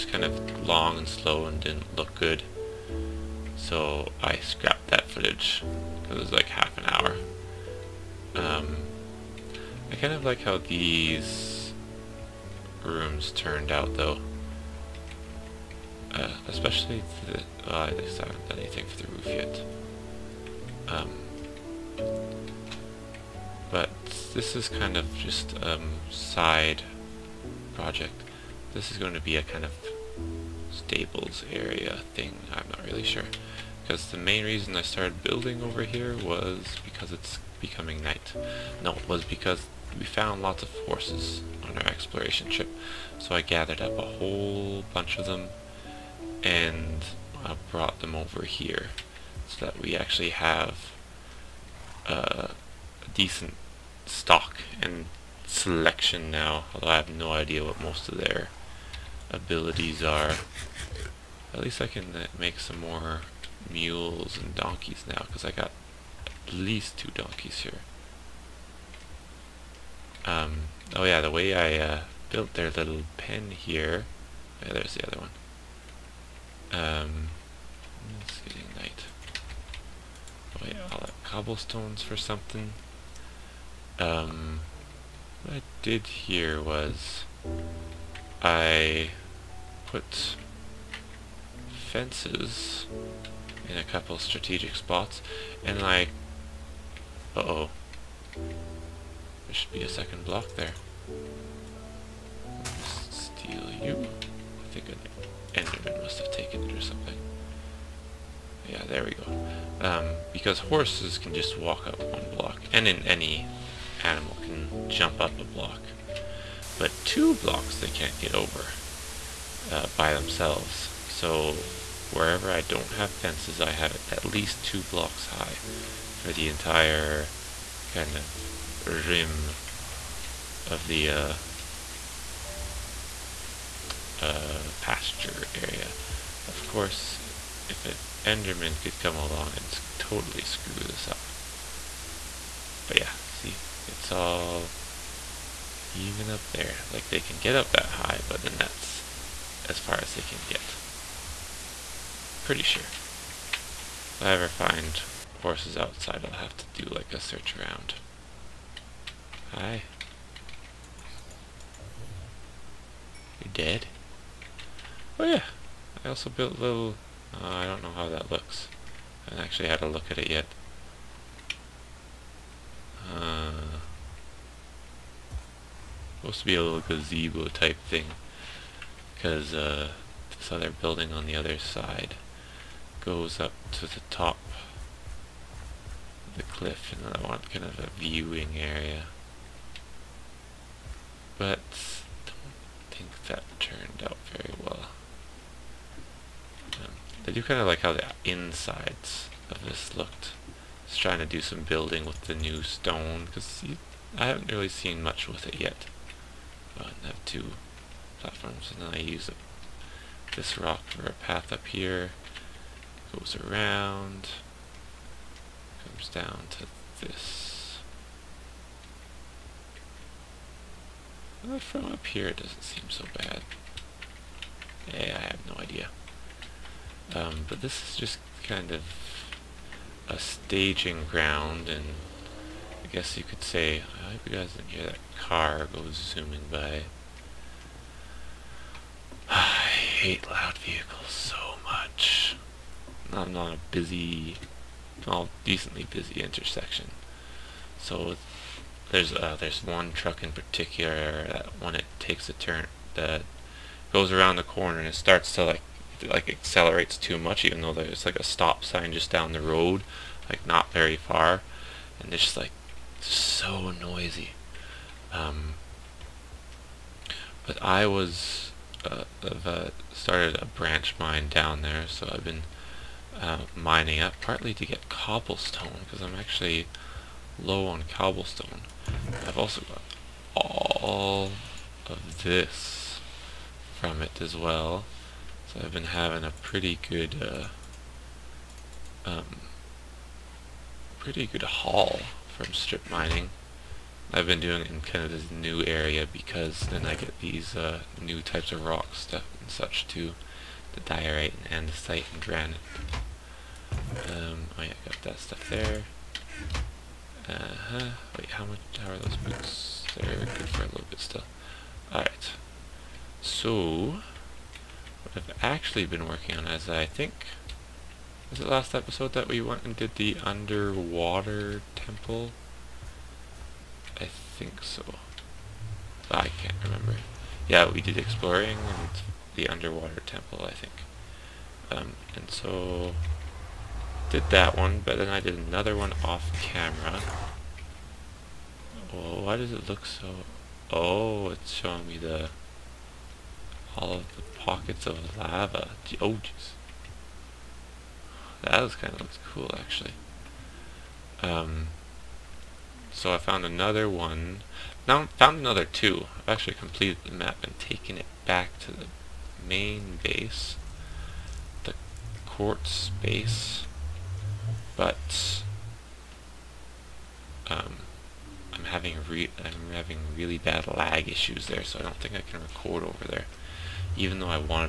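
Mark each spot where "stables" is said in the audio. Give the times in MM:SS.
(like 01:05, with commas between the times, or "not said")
00:30.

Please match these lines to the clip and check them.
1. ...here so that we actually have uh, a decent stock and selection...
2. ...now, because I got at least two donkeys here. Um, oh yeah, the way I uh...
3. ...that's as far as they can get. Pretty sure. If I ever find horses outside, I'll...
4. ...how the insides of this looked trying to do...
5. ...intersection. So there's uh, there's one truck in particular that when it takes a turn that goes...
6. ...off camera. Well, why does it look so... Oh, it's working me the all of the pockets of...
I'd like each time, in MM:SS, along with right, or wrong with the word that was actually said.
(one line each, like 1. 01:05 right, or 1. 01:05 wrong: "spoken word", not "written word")
1. 00:48 right
2. 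01:05 right
3. 02:28 right
4. 03:17 right
5. 04:06 right
6. 05:36 wrong: "showing", not "working".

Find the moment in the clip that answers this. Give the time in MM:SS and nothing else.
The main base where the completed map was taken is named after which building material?
06:01.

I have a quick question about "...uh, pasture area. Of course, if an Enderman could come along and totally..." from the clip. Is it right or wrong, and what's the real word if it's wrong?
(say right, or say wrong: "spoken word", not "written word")
right.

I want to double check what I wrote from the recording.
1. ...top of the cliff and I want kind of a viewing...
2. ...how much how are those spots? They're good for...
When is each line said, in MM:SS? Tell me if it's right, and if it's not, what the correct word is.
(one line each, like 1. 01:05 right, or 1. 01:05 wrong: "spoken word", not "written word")
1. 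03:04 right
2. 05:08 wrong: "boots", not "spots".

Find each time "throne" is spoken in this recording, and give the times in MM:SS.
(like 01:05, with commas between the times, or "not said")
not said.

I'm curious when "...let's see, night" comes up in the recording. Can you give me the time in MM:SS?
01:18.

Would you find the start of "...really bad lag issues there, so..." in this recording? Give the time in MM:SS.
06:10.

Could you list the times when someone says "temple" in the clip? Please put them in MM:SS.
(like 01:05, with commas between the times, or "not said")
05:21, 05:30.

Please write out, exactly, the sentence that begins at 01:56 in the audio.
But two blocks they can't get over uh, by themselves.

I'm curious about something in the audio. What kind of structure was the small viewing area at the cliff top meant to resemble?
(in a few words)
gazebo.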